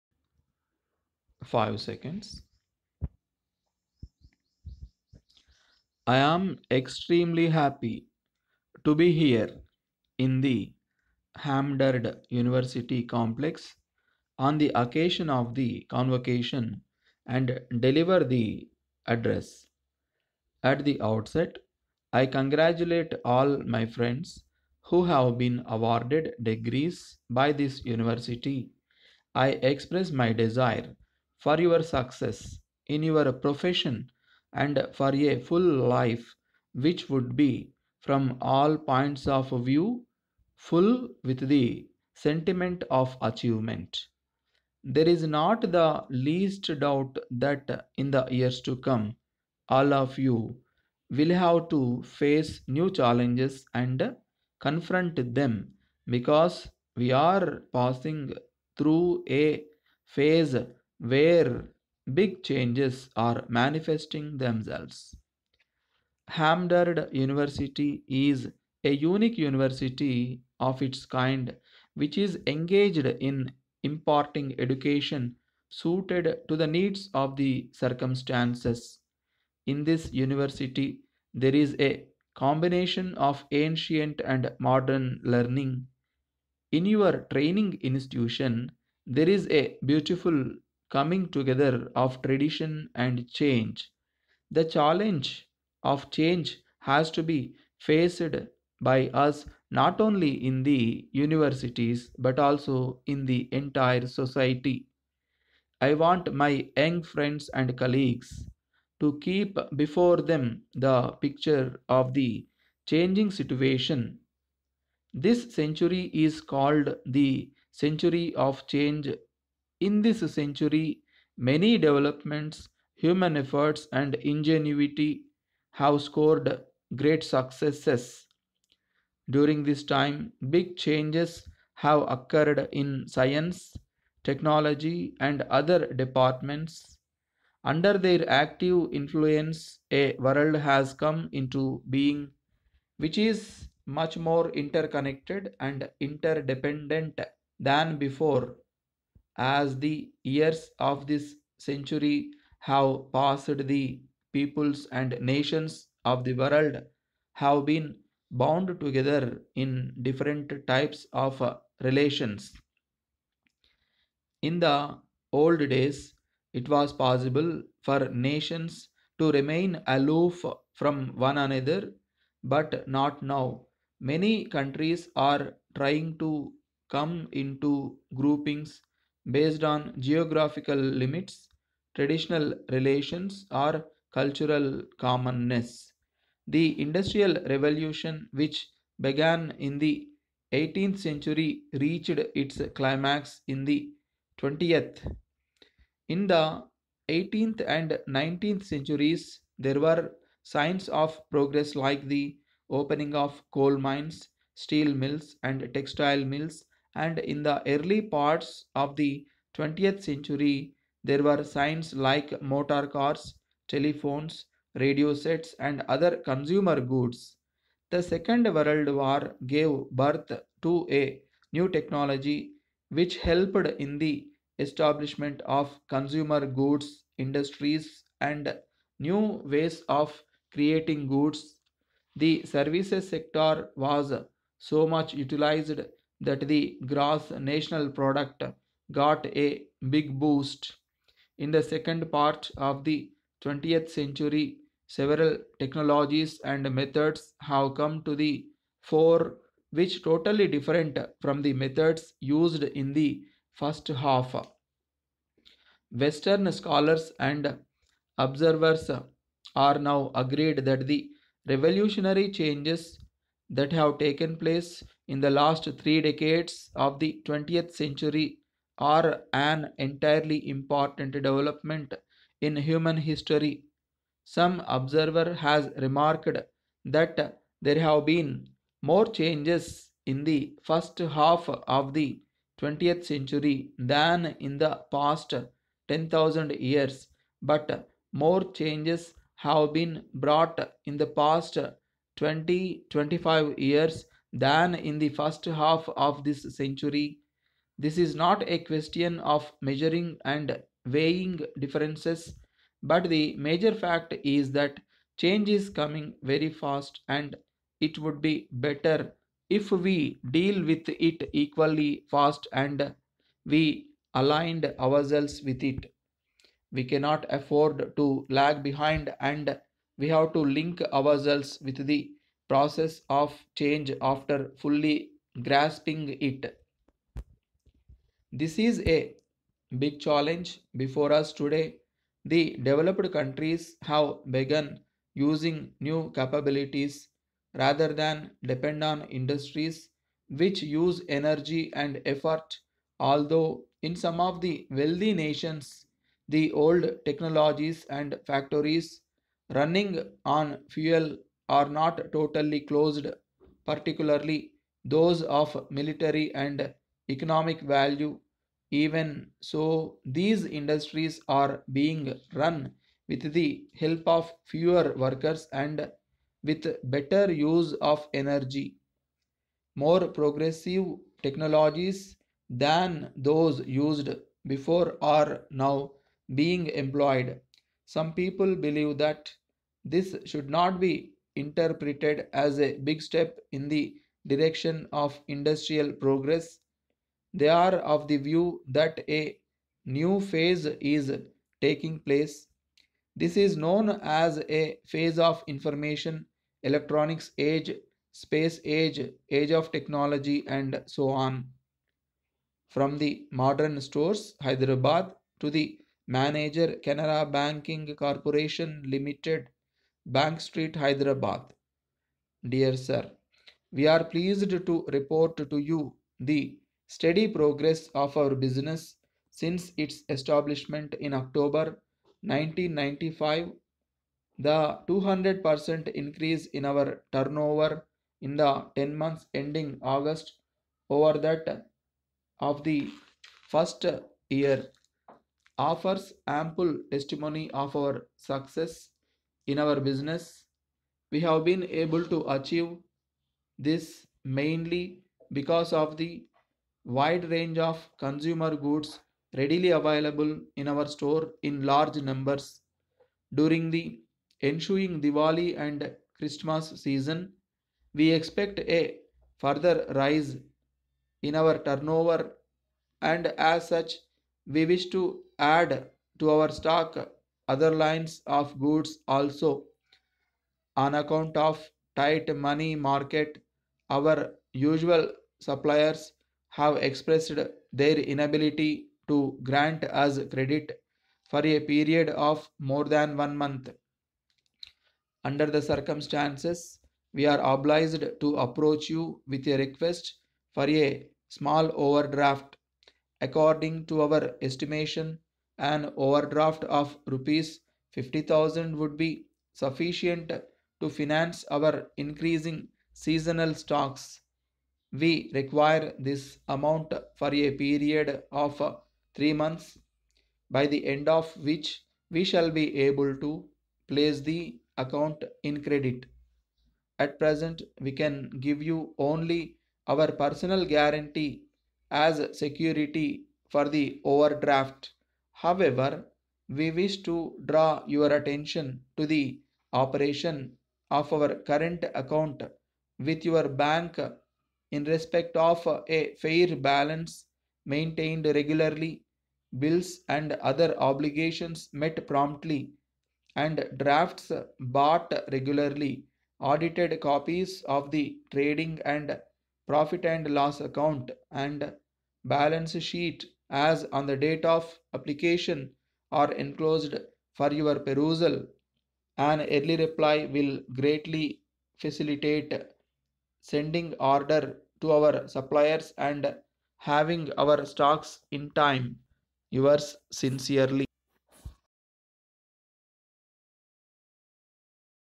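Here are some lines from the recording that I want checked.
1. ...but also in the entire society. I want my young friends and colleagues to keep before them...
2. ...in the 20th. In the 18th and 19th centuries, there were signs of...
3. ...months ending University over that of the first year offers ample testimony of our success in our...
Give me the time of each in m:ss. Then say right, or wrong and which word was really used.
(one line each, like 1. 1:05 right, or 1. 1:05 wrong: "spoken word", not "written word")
1. 1:42 right
2. 3:13 right
3. 7:08 wrong: "August", not "University".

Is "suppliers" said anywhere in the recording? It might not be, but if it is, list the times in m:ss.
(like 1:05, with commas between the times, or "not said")
7:55, 9:25.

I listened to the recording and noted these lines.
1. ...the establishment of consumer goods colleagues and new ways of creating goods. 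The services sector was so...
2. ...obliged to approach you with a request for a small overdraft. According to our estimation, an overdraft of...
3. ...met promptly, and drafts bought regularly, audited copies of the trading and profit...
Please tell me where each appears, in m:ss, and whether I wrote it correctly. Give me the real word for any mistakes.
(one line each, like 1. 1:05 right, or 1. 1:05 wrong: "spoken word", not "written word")
1. 3:43 wrong: "industries", not "colleagues"
2. 8:07 right
3. 9:01 right.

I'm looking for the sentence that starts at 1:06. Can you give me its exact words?
Hamdard University is a unique university of its kind which is engaged in imparting education suited to the needs of the circumstances.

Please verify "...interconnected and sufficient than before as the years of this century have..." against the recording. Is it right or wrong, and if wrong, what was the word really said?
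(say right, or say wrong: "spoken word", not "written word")
wrong: "interdependent", not "sufficient".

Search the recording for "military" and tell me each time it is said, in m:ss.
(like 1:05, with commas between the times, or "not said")
5:55.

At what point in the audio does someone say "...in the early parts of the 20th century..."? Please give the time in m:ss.
3:27.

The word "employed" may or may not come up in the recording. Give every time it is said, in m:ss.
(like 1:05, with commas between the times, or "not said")
6:16.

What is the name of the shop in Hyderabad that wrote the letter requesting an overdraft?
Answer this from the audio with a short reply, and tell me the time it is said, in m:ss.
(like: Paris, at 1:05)
The Modern Stores, at 6:42.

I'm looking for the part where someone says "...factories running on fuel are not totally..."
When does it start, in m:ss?
5:48.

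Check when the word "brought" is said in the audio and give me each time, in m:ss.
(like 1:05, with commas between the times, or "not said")
4:50.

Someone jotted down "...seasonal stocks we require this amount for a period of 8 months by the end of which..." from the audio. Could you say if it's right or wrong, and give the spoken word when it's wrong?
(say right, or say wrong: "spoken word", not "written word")
wrong: "3", not "8".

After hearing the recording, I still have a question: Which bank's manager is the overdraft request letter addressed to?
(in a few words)
Canara Banking Corporation Limited.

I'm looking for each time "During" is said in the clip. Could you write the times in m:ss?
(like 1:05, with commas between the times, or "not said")
2:09, 7:33.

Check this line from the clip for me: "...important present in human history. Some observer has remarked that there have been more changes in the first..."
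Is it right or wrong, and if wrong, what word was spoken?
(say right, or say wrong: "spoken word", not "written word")
wrong: "development", not "present".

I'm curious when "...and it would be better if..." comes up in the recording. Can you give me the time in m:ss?
5:07.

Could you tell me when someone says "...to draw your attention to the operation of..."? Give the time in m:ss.
8:47.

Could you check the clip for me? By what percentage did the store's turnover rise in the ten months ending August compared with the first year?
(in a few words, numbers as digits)
200%.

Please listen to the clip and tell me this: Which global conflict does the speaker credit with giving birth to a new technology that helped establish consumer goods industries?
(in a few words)
The Second World War.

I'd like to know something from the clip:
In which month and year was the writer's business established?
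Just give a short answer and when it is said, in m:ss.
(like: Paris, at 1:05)
October 1995, at 7:01.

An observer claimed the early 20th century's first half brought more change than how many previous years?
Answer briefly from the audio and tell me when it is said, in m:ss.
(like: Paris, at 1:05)
10,000 years, at 4:45.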